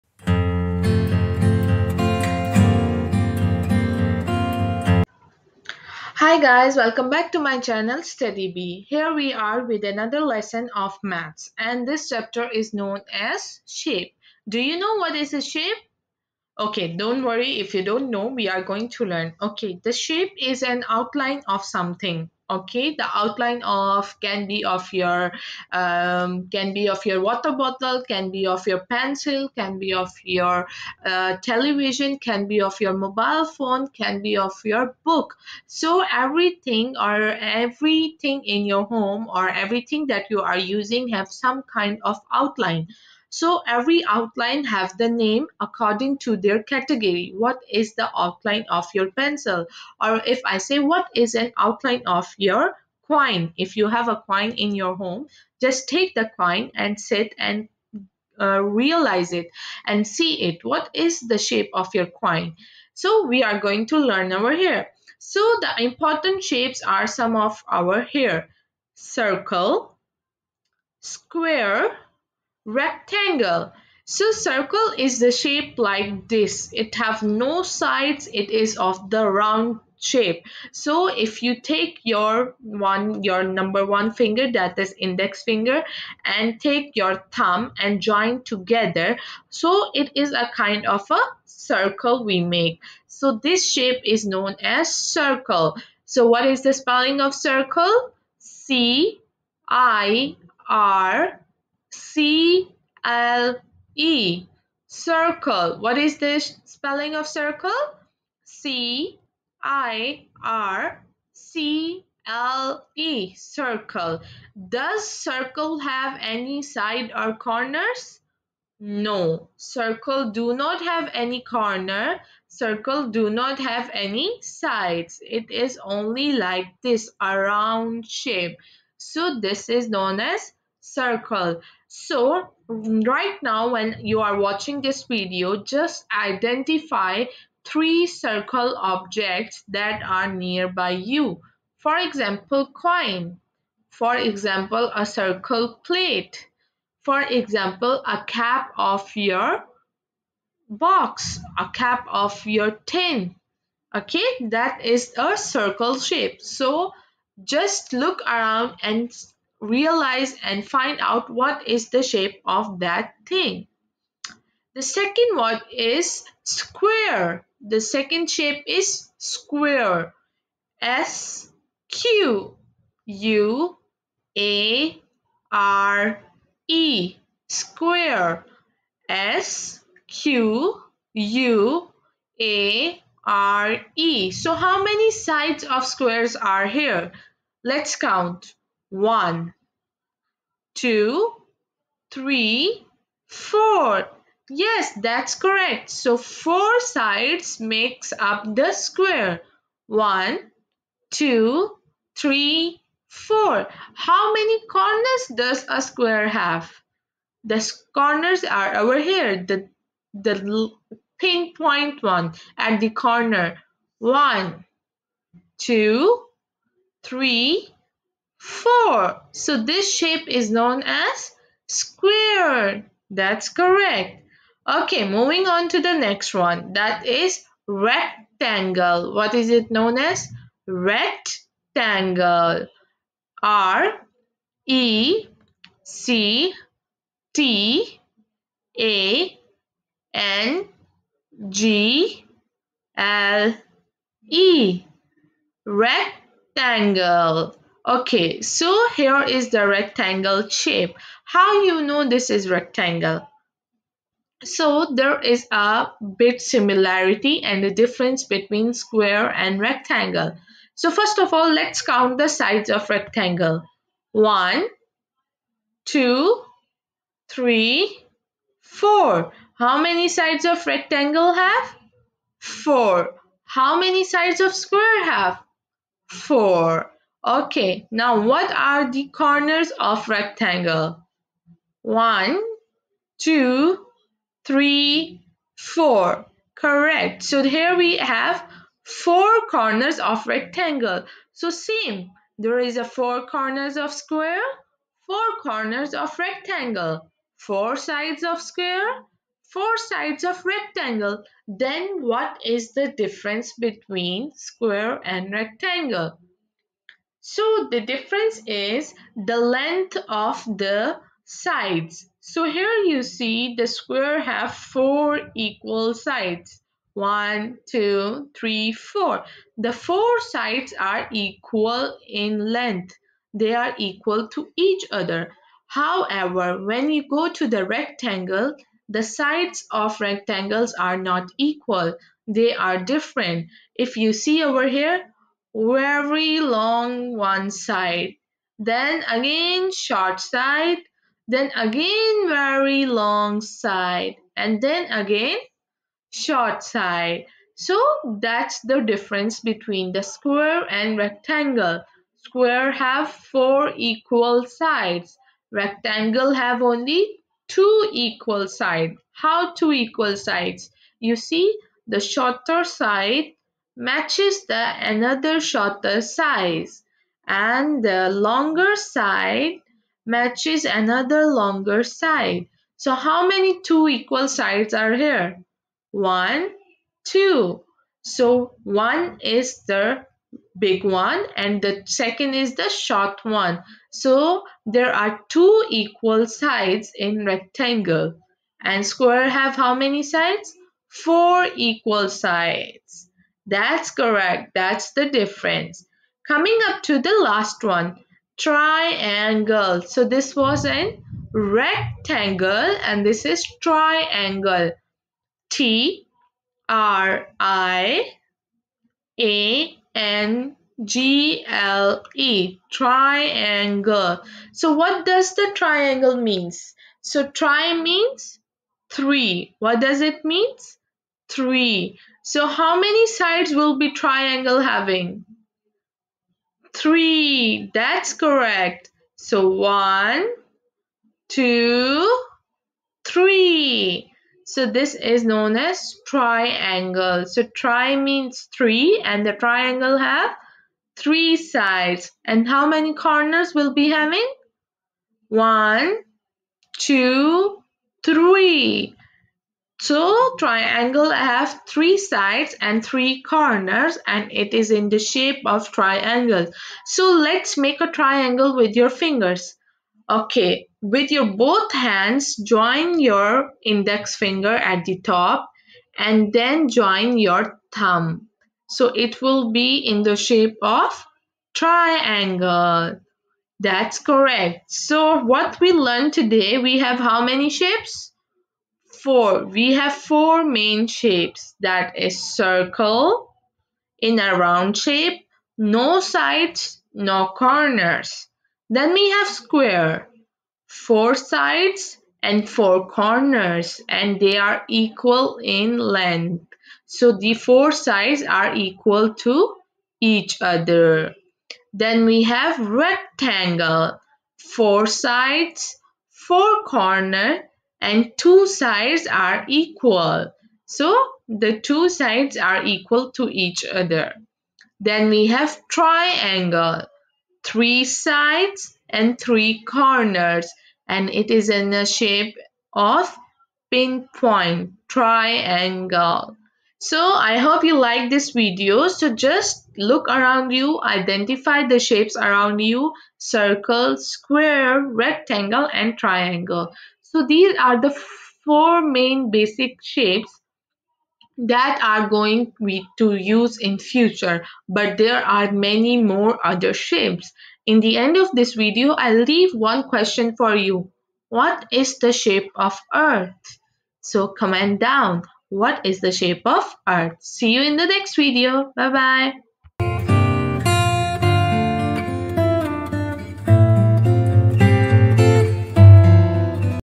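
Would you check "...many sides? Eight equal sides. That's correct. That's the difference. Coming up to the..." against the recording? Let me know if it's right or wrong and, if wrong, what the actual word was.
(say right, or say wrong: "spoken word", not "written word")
wrong: "Four", not "Eight".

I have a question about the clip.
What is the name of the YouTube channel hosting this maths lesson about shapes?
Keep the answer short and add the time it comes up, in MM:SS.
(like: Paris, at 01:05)
Study Bee, at 00:08.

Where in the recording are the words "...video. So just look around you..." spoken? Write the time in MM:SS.
08:48.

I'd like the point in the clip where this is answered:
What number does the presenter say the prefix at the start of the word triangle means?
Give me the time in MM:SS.
06:57.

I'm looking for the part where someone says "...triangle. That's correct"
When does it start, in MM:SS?
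07:51.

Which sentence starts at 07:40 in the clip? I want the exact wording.
Okay, with your both hands, join your index finger at the top and then join your thumb.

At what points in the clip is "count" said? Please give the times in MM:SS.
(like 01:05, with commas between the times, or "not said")
03:07, 04:21.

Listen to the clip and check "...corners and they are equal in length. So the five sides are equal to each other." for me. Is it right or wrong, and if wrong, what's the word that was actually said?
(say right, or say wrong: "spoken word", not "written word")
wrong: "four", not "five".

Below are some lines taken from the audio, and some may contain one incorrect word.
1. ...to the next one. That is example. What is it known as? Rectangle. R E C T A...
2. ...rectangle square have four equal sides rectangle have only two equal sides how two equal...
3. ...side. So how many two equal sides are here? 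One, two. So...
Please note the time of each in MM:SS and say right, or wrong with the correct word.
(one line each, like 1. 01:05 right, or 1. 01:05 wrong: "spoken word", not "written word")
1. 03:45 wrong: "rectangle", not "example"
2. 05:50 right
3. 06:11 right.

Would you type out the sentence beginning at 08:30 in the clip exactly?
So the two sides are equal to each other.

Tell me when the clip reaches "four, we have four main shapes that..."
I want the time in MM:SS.
07:59.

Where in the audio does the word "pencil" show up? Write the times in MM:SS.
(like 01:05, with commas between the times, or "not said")
00:28, 00:49.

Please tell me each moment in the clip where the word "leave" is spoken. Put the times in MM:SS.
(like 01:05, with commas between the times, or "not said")
09:09.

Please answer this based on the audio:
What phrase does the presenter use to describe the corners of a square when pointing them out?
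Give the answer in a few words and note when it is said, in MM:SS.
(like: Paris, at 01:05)
the pinpoint one, at 03:30.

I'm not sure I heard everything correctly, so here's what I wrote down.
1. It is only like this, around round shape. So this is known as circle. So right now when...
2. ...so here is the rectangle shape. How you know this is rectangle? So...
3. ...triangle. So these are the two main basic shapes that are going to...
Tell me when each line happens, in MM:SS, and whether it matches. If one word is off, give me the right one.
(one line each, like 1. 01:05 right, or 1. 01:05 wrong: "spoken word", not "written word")
1. 02:05 right
2. 04:08 right
3. 08:55 wrong: "four", not "two".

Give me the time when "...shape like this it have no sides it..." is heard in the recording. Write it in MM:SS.
01:15.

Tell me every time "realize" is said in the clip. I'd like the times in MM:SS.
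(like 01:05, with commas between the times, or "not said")
00:58, 02:39.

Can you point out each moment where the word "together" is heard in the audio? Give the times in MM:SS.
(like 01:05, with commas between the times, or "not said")
01:28.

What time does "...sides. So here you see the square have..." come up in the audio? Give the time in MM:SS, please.
05:11.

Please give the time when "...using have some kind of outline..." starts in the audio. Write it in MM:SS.
00:40.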